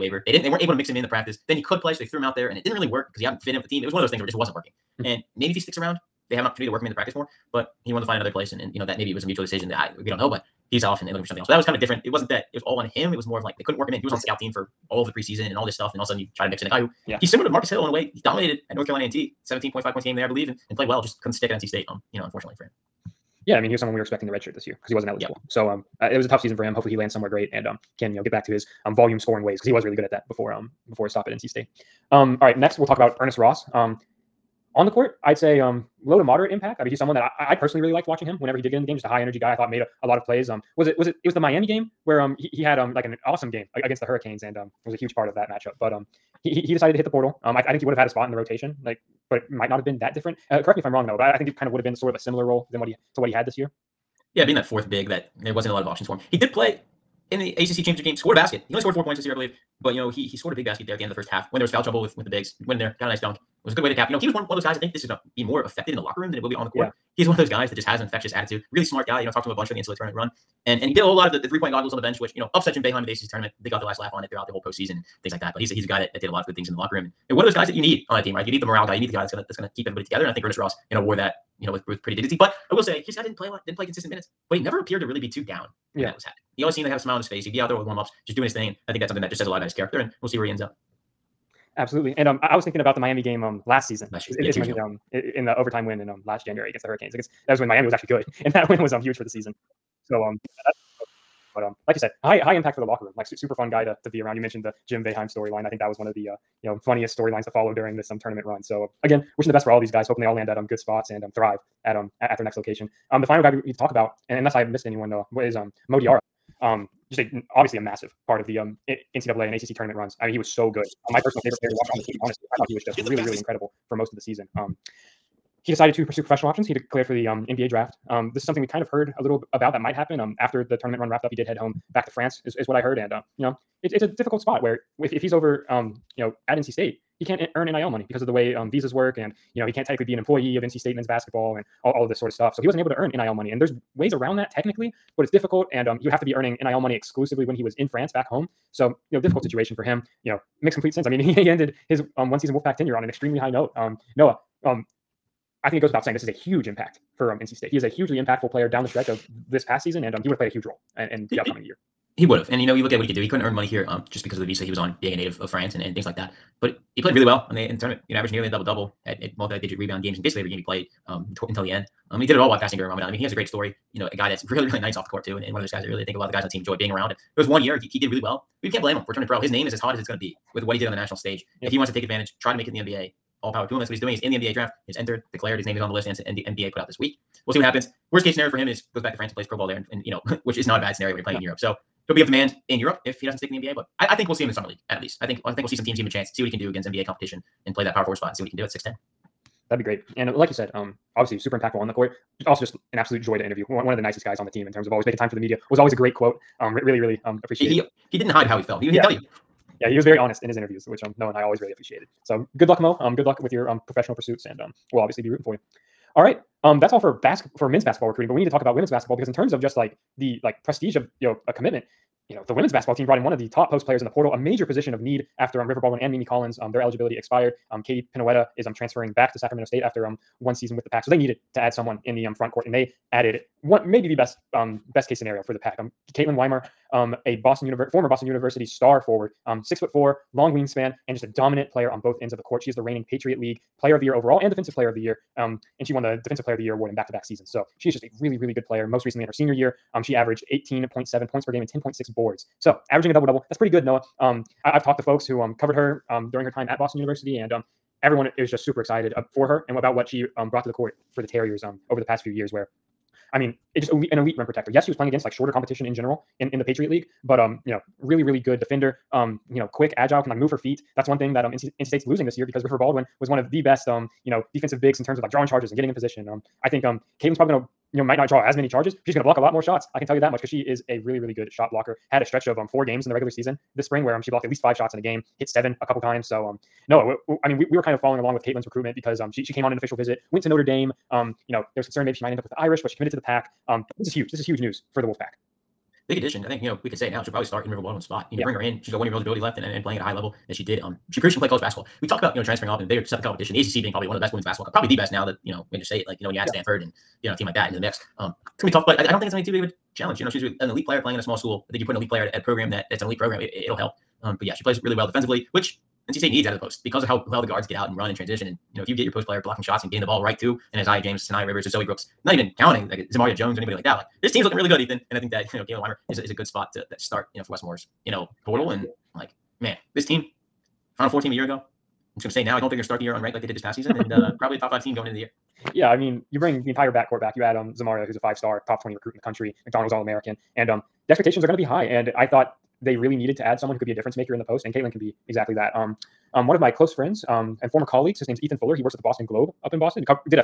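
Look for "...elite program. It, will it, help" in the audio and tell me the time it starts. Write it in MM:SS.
05:13.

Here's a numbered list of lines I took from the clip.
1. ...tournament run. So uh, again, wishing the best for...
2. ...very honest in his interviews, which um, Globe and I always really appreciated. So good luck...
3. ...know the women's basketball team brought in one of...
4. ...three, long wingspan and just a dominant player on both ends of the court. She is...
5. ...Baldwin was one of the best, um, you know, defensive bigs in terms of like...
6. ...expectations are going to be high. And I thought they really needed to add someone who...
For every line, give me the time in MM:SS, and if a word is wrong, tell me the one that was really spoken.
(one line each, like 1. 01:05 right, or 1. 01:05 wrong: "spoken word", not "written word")
1. 01:48 right
2. 03:30 wrong: "Noah", not "Globe"
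3. 03:42 right
4. 03:59 wrong: "four", not "three"
5. 04:32 right
6. 05:41 right.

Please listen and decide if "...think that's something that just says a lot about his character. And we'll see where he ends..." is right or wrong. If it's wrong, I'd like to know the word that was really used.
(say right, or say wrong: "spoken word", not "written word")
right.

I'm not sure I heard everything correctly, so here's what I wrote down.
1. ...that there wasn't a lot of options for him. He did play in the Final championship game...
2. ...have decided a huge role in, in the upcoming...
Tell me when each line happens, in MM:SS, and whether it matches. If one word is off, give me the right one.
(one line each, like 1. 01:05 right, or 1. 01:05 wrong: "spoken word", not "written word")
1. 00:55 wrong: "ACC", not "Final"
2. 02:40 wrong: "played", not "decided".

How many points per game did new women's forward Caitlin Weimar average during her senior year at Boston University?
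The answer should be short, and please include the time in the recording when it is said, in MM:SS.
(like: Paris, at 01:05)
18.7, at 04:10.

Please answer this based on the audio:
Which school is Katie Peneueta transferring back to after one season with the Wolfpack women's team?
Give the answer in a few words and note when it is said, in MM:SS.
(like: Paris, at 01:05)
Sacramento State, at 03:49.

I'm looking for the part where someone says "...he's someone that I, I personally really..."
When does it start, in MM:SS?
00:36.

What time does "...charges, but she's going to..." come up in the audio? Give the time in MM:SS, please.
04:38.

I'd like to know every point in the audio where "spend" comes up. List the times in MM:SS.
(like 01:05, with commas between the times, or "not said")
not said.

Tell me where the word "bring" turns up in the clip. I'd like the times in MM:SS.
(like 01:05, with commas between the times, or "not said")
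04:58, 05:36.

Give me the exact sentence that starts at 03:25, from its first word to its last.
It was always a great quote.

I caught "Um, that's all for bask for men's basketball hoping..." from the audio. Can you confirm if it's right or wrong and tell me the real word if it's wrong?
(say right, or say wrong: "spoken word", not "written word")
wrong: "recruiting", not "hoping".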